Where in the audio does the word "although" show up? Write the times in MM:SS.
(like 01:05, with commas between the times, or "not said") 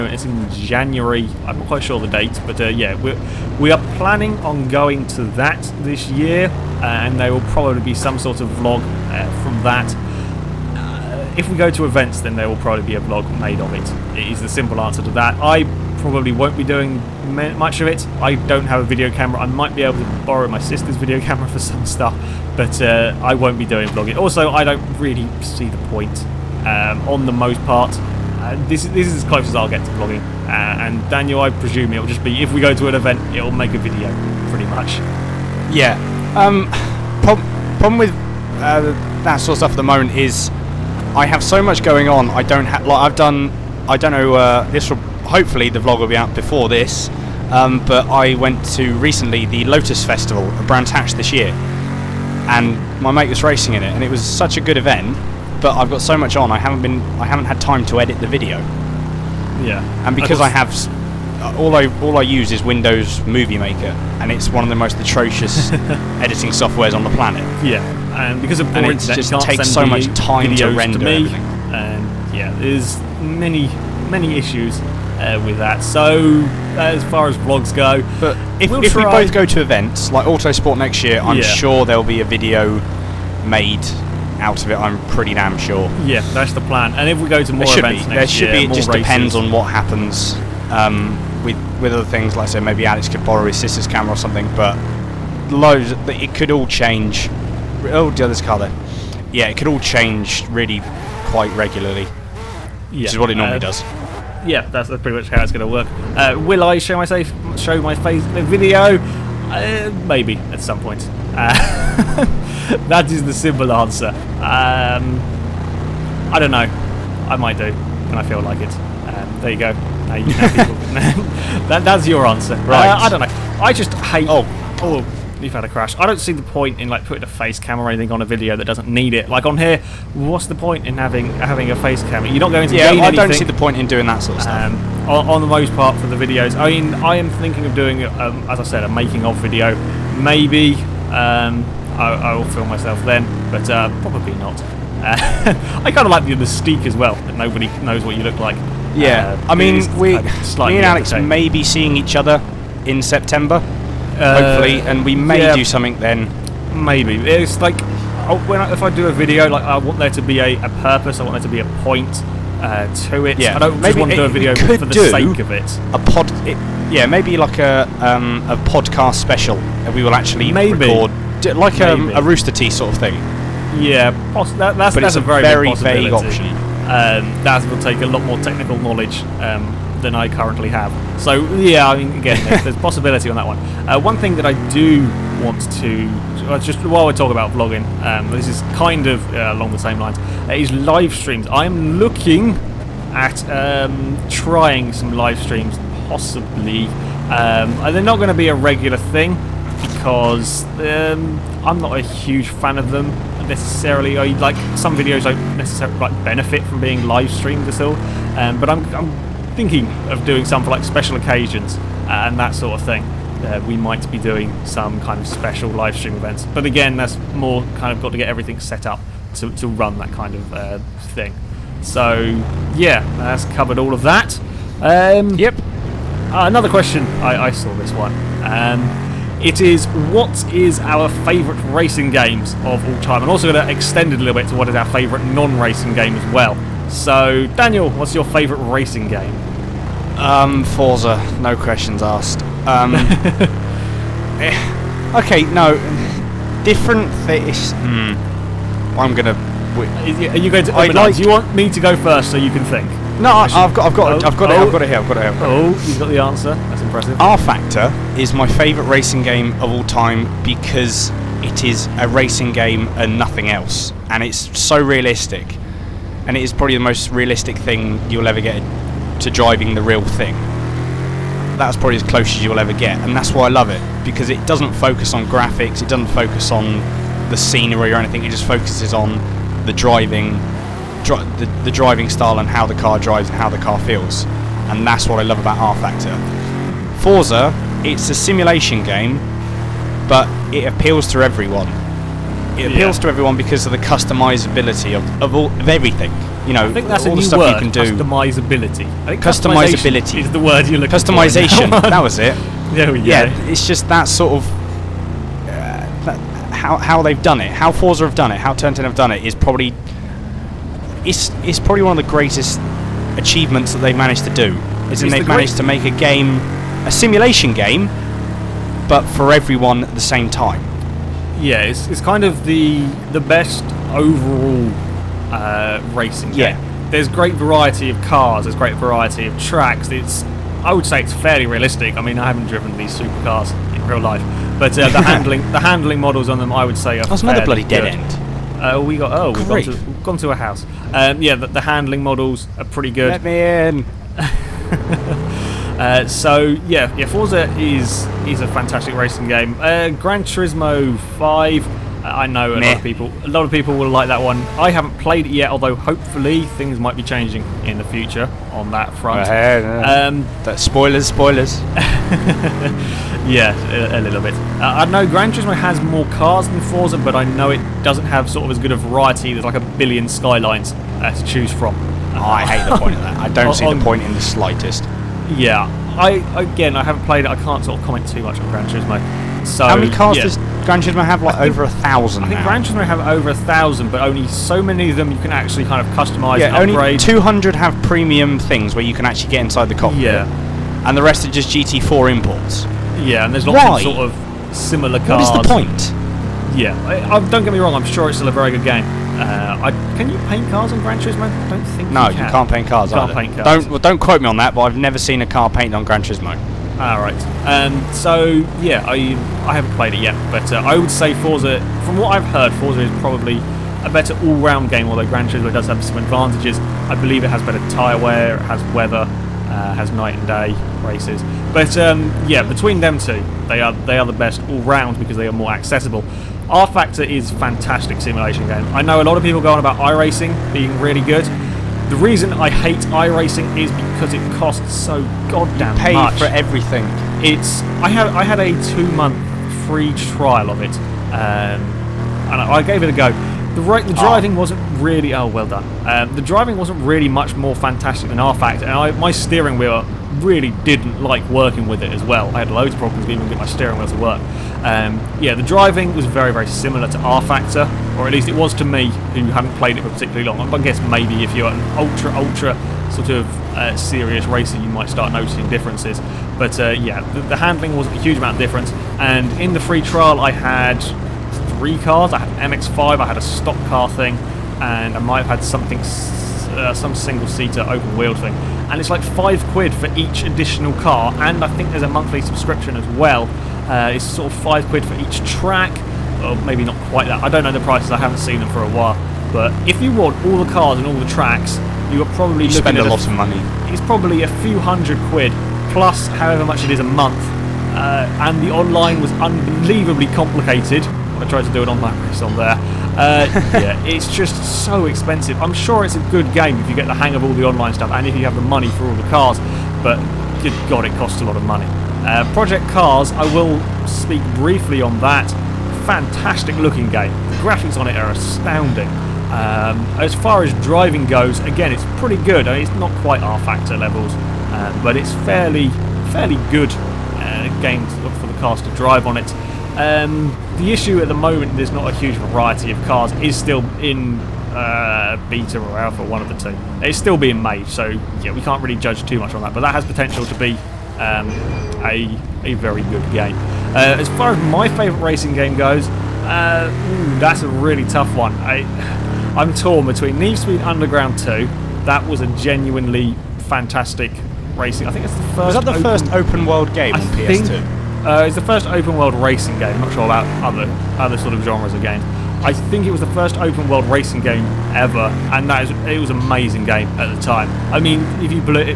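05:55, 06:54.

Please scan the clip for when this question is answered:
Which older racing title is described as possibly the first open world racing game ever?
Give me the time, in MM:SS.
09:10.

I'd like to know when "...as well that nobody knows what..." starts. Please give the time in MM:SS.
02:26.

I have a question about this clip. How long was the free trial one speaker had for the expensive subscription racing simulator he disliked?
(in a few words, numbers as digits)
2 months.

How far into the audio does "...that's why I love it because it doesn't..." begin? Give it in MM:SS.
04:33.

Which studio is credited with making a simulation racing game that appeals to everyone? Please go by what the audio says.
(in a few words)
Turn 10.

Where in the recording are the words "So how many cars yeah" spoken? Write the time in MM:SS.
06:19.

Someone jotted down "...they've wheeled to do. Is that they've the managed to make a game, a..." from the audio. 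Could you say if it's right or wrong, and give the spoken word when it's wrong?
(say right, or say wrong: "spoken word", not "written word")
wrong: "managed", not "wheeled".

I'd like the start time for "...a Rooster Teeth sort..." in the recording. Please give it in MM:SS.
02:52.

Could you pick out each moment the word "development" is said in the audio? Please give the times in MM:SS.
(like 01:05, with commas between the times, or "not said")
not said.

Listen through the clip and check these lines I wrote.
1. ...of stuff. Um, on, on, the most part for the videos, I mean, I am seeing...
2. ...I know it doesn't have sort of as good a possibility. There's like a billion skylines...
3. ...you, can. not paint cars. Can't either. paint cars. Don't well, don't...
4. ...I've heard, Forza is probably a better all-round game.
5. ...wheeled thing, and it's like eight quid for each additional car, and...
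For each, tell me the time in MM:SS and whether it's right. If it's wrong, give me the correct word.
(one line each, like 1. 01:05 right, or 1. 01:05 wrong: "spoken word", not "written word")
1. 02:14 wrong: "thinking", not "seeing"
2. 06:07 wrong: "variety", not "possibility"
3. 06:42 right
4. 06:52 right
5. 07:57 wrong: "five", not "eight".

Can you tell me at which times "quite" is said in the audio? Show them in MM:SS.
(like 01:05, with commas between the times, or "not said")
00:01, 01:41, 08:06, 08:43.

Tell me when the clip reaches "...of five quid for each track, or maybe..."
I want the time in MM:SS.
08:04.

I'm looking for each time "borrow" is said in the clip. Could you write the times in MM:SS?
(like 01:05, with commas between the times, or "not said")
00:20, 01:33.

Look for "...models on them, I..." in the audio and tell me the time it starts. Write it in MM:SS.
05:36.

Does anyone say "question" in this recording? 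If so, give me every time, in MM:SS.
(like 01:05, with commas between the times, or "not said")
03:46, 04:01.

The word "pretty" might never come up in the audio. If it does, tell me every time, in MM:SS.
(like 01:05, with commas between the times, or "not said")
00:34, 01:25, 01:44, 05:42, 08:41.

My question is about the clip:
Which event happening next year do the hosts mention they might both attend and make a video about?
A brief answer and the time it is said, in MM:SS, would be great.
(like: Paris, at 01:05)
Autosport, at 01:20.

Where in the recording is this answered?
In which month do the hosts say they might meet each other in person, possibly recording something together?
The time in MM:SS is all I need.
02:33.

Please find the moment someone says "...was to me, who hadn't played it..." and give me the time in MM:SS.
07:38.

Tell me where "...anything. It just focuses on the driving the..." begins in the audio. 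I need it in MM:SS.
04:37.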